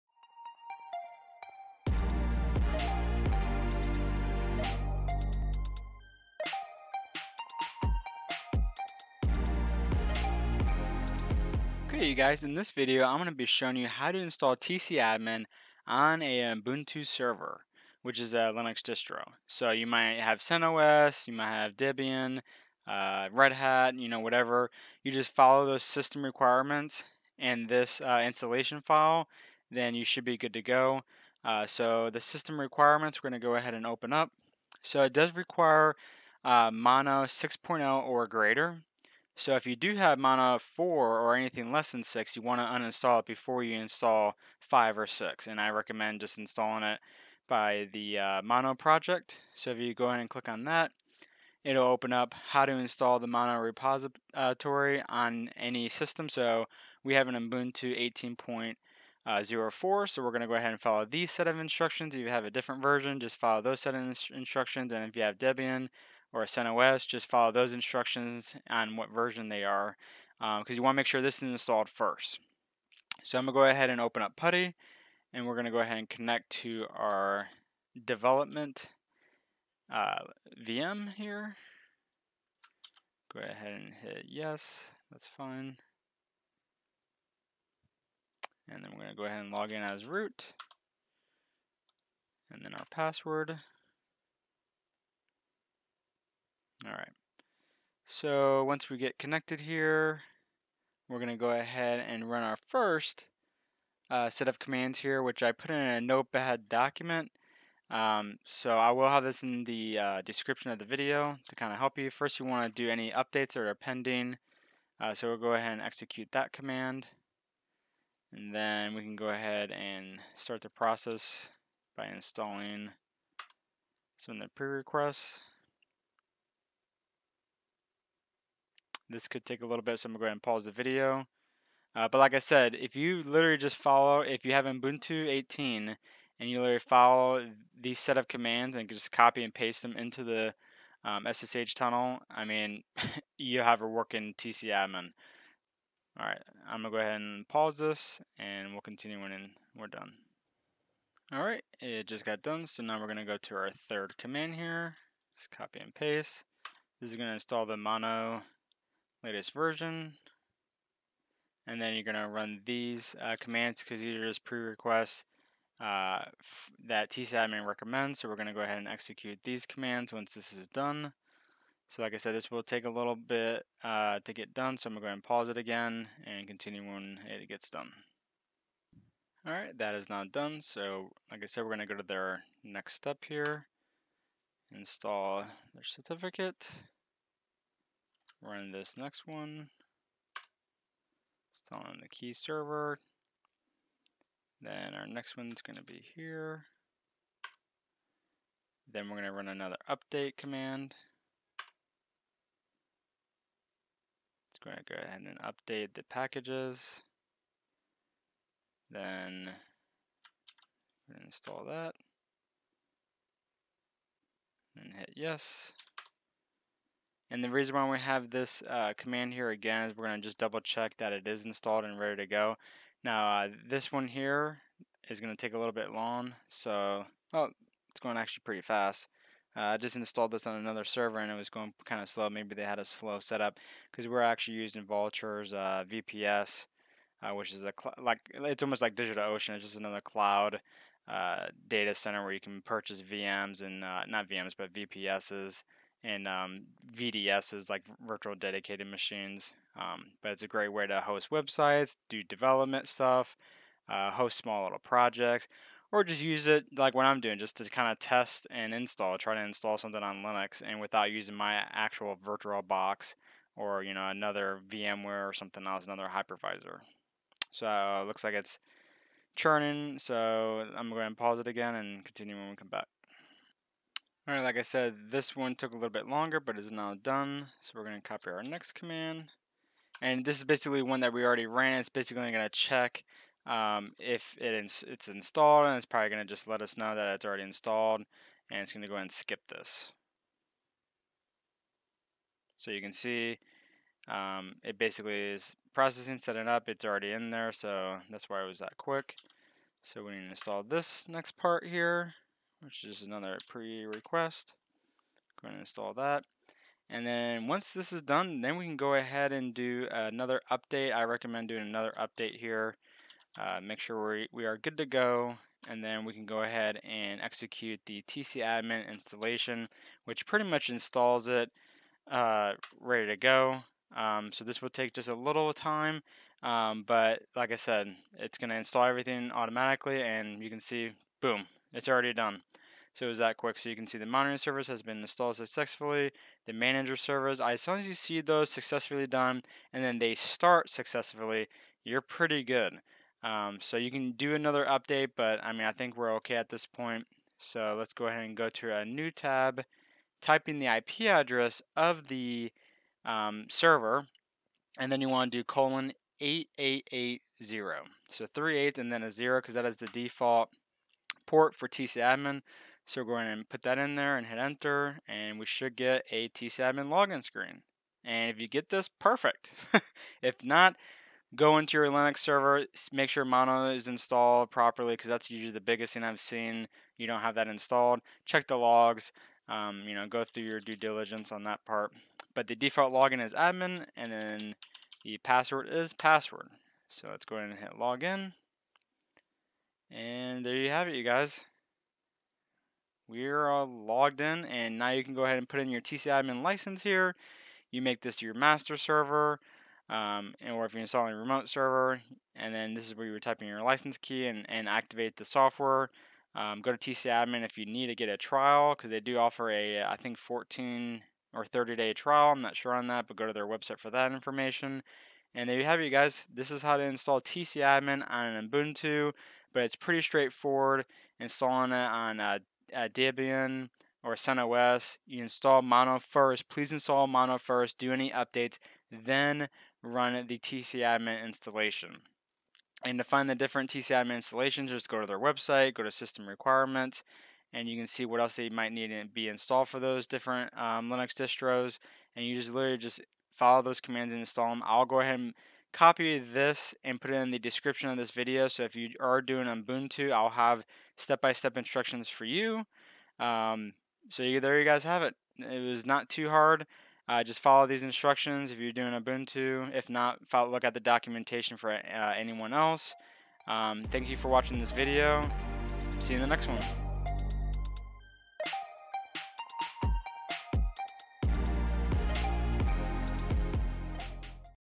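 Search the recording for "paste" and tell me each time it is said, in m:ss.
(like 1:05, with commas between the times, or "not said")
2:19, 2:35.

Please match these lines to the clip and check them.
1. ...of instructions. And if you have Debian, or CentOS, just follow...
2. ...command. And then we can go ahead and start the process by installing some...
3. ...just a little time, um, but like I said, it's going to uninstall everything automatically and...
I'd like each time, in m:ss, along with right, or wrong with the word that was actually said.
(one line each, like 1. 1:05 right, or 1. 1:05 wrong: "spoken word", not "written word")
1. 1:03 right
2. 1:56 right
3. 5:24 wrong: "install", not "uninstall".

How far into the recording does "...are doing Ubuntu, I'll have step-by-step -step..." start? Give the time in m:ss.
7:28.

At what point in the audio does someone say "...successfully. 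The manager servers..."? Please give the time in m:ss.
5:35.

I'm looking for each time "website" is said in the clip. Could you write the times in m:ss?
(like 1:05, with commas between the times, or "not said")
4:11, 6:53, 7:15.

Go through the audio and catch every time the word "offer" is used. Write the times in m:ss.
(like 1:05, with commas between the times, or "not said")
6:49.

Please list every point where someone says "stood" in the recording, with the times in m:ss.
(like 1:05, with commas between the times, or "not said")
not said.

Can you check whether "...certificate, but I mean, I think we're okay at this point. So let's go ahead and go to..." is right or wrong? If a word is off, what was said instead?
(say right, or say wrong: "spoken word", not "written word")
wrong: "update", not "certificate".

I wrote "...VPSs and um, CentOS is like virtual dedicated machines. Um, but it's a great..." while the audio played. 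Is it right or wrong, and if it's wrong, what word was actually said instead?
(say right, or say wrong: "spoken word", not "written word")
wrong: "VDS", not "CentOS".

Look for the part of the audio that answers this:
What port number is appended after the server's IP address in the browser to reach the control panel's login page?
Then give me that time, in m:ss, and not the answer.
5:56.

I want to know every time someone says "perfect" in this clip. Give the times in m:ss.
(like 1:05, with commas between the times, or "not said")
6:08.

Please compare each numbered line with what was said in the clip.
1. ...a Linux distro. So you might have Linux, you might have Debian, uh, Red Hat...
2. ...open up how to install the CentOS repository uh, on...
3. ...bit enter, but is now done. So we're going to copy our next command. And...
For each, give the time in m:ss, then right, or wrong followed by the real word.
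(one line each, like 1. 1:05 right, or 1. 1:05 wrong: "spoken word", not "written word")
1. 0:18 wrong: "CentOS", not "Linux"
2. 0:51 wrong: "Mono", not "CentOS"
3. 4:35 wrong: "longer", not "enter".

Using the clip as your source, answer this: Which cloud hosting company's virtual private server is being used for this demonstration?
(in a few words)
Vultr.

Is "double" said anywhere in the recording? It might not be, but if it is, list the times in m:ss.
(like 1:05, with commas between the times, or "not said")
3:40.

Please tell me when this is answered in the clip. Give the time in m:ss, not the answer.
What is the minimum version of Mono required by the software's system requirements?
0:36.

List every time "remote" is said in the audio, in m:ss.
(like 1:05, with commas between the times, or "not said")
6:41.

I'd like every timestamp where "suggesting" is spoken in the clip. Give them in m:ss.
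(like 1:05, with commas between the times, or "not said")
not said.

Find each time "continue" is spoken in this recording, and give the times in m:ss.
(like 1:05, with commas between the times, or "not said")
2:28, 2:56, 4:32.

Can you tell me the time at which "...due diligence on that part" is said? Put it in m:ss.
6:20.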